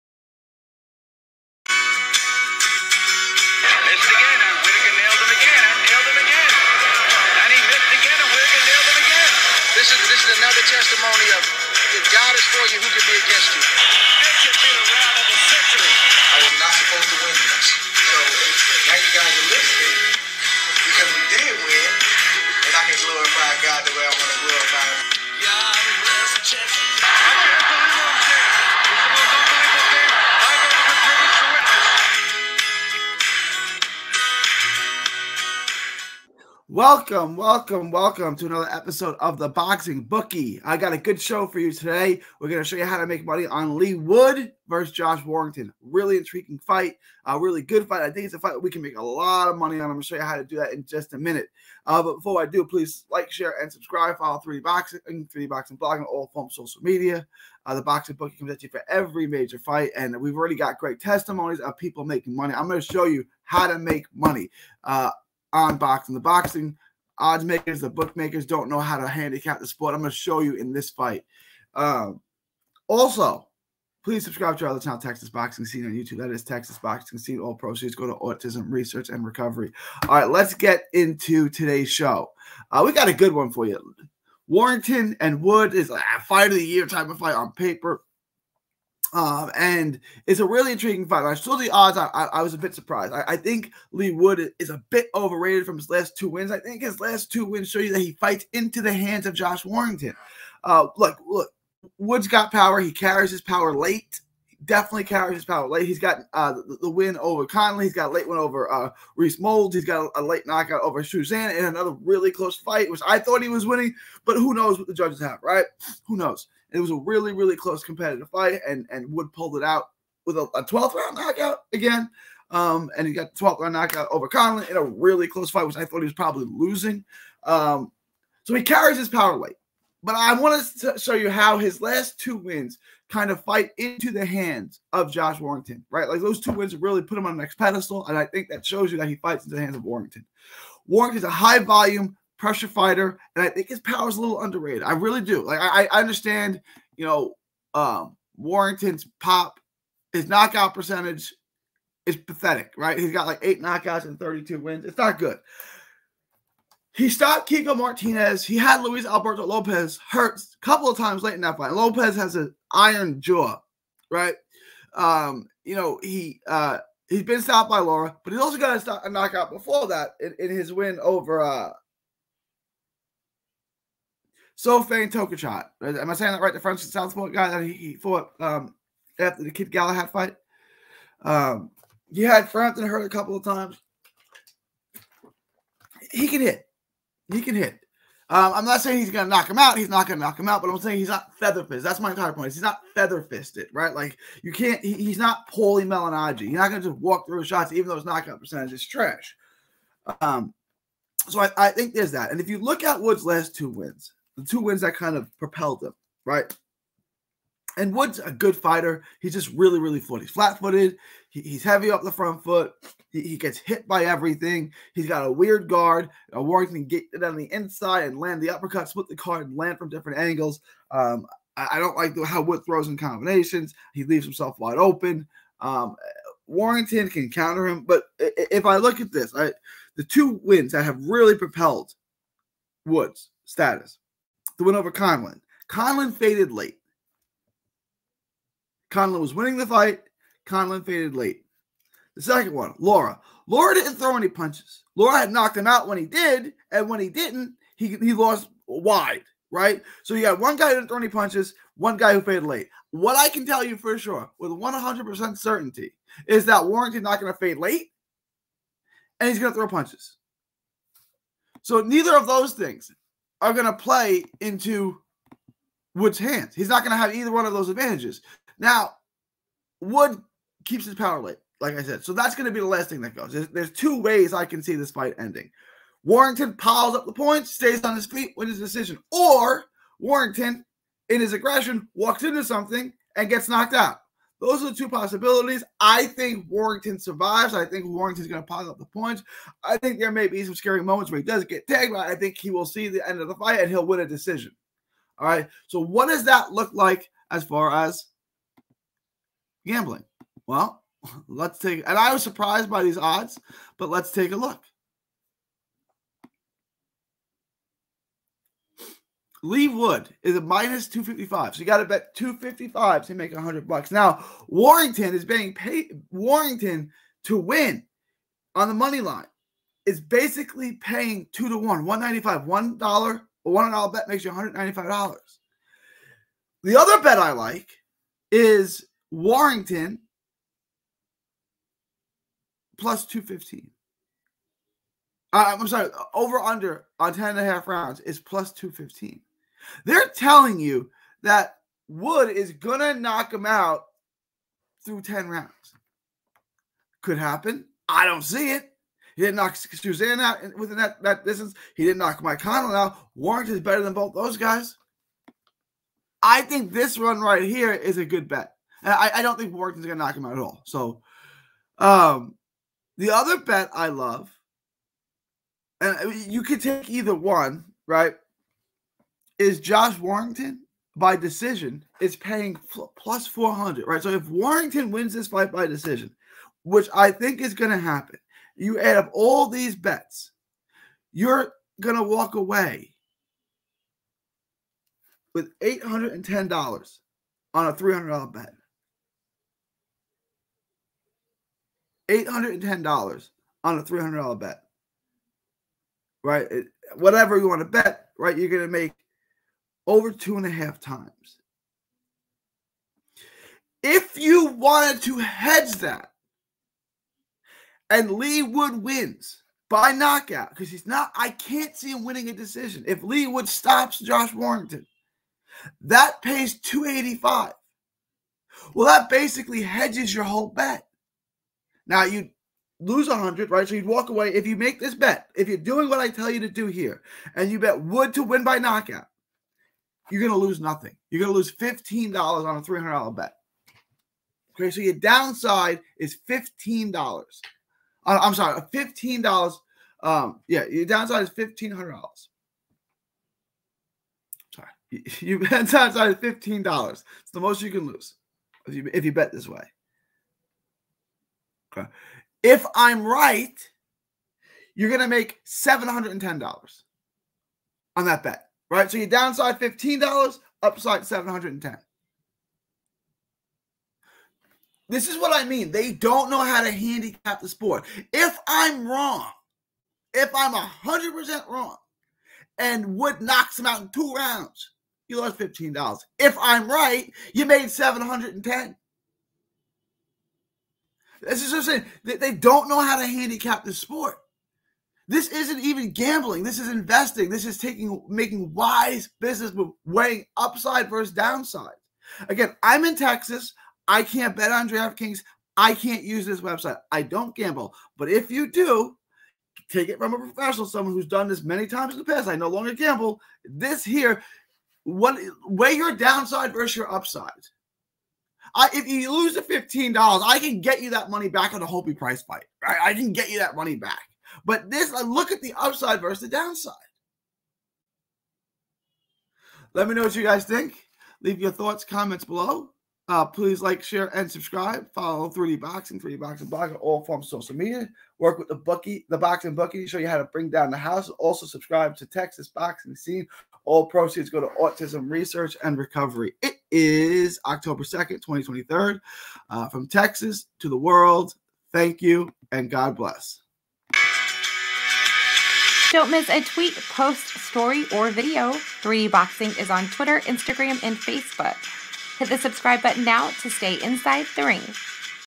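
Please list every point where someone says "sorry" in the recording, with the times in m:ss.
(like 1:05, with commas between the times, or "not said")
5:35, 7:18, 7:24.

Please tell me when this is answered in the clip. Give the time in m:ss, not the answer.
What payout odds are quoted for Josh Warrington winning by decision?
6:12.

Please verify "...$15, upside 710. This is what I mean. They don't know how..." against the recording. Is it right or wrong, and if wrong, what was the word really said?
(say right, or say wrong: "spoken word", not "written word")
right.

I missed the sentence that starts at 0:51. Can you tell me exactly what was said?
Uh, but before I do, please like, share, and subscribe.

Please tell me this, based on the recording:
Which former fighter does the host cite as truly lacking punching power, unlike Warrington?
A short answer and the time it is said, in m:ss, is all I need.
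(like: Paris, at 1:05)
Paulie Malignaggi, at 3:15.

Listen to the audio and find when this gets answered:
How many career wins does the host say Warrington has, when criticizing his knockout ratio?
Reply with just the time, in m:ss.
2:34.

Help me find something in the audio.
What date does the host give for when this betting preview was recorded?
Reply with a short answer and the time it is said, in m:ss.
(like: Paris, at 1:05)
October 2, 2023, at 8:57.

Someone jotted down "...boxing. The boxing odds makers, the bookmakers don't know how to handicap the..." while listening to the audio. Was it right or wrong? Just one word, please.
right.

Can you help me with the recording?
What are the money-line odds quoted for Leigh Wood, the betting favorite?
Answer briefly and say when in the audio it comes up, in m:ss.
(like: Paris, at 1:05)
-255, at 5:10.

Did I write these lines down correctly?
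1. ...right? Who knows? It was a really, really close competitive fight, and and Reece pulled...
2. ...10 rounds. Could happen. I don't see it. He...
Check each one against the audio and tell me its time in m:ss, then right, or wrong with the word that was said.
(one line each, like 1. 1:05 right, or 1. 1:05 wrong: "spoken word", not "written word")
1. 1:55 wrong: "Wood", not "Reece"
2. 5:45 right.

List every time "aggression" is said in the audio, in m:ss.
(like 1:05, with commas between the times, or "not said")
4:41.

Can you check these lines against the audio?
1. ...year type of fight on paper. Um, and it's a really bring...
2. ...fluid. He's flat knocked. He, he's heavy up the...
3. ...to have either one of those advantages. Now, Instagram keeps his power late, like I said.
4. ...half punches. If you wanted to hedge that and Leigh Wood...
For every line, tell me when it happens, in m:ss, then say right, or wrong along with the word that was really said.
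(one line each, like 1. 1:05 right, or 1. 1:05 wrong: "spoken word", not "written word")
1. 1:26 wrong: "intriguing", not "bring"
2. 3:30 wrong: "footed", not "knocked"
3. 4:26 wrong: "Wood", not "Instagram"
4. 6:40 wrong: "times", not "punches".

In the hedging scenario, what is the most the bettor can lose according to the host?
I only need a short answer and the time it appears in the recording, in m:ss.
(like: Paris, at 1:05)
$15, at 7:11.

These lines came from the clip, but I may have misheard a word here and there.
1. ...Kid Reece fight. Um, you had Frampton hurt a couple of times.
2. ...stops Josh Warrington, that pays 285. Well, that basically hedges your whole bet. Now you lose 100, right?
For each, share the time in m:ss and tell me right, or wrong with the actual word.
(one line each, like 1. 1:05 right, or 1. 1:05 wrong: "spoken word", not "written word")
1. 2:59 wrong: "Galahad", not "Reece"
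2. 6:53 right.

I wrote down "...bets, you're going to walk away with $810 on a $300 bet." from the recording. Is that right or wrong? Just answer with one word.
right.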